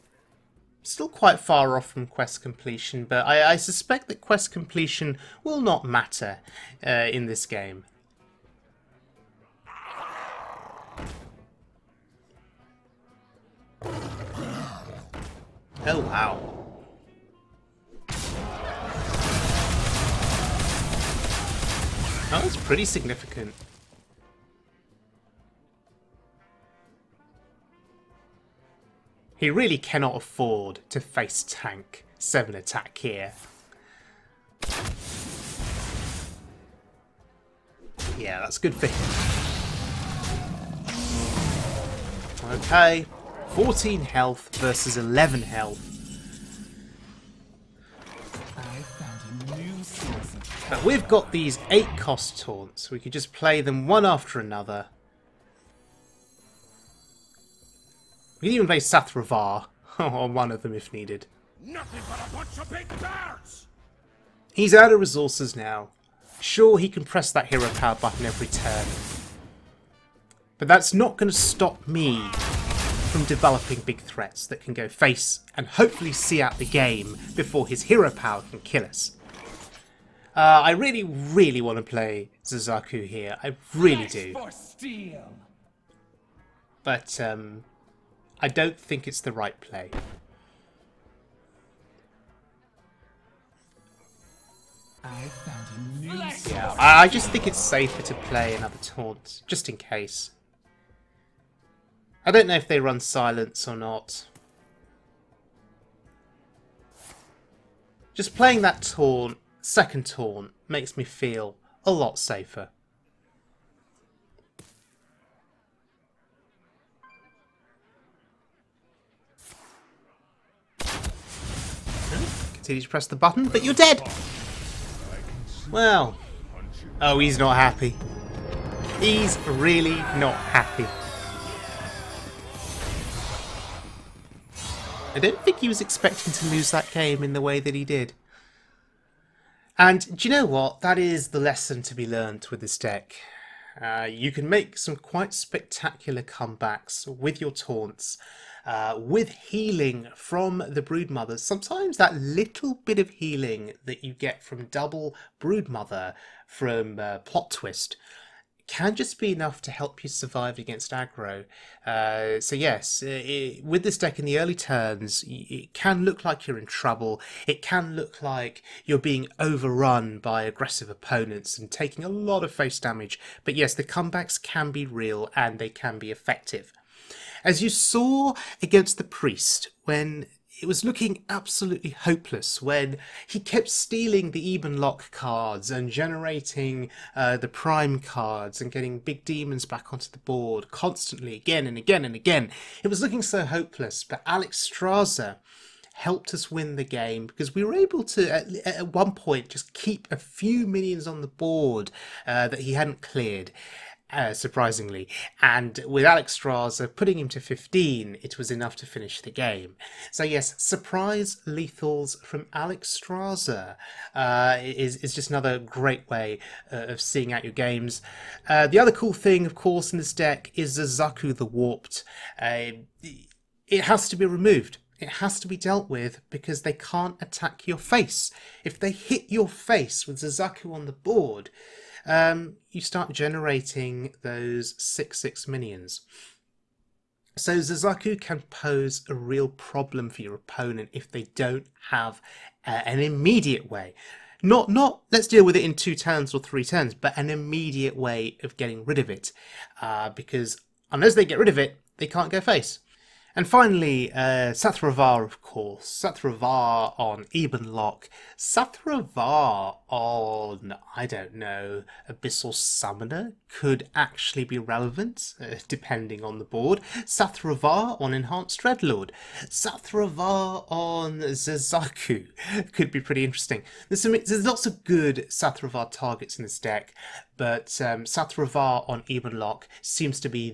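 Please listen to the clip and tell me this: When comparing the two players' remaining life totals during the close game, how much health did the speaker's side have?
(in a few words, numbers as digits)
14.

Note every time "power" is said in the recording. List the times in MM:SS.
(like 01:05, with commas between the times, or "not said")
01:07, 01:18.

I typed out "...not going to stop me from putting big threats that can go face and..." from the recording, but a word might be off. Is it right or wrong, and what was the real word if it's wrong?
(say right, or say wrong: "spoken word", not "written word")
wrong: "developing", not "putting".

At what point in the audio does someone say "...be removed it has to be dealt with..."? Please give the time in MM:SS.
03:44.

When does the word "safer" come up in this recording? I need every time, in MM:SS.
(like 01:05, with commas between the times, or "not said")
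01:37, 01:52.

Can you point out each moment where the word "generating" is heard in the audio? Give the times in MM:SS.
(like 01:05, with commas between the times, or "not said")
03:05, 03:53.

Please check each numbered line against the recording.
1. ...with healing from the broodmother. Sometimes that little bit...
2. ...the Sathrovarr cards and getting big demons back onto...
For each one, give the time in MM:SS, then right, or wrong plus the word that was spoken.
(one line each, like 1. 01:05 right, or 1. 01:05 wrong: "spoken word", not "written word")
1. 02:28 right
2. 03:07 wrong: "Prime", not "Sathrovarr".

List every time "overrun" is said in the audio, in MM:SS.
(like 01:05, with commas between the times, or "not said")
02:49.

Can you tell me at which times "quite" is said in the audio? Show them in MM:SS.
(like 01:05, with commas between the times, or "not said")
00:01, 02:24.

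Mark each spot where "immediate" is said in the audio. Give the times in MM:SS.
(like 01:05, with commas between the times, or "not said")
04:02, 04:07.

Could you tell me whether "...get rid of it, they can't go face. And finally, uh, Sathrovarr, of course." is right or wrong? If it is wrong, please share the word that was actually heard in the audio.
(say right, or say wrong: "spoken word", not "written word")
right.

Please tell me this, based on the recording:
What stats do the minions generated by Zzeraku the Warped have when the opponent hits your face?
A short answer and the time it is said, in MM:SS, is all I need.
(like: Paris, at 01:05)
6-6, at 03:54.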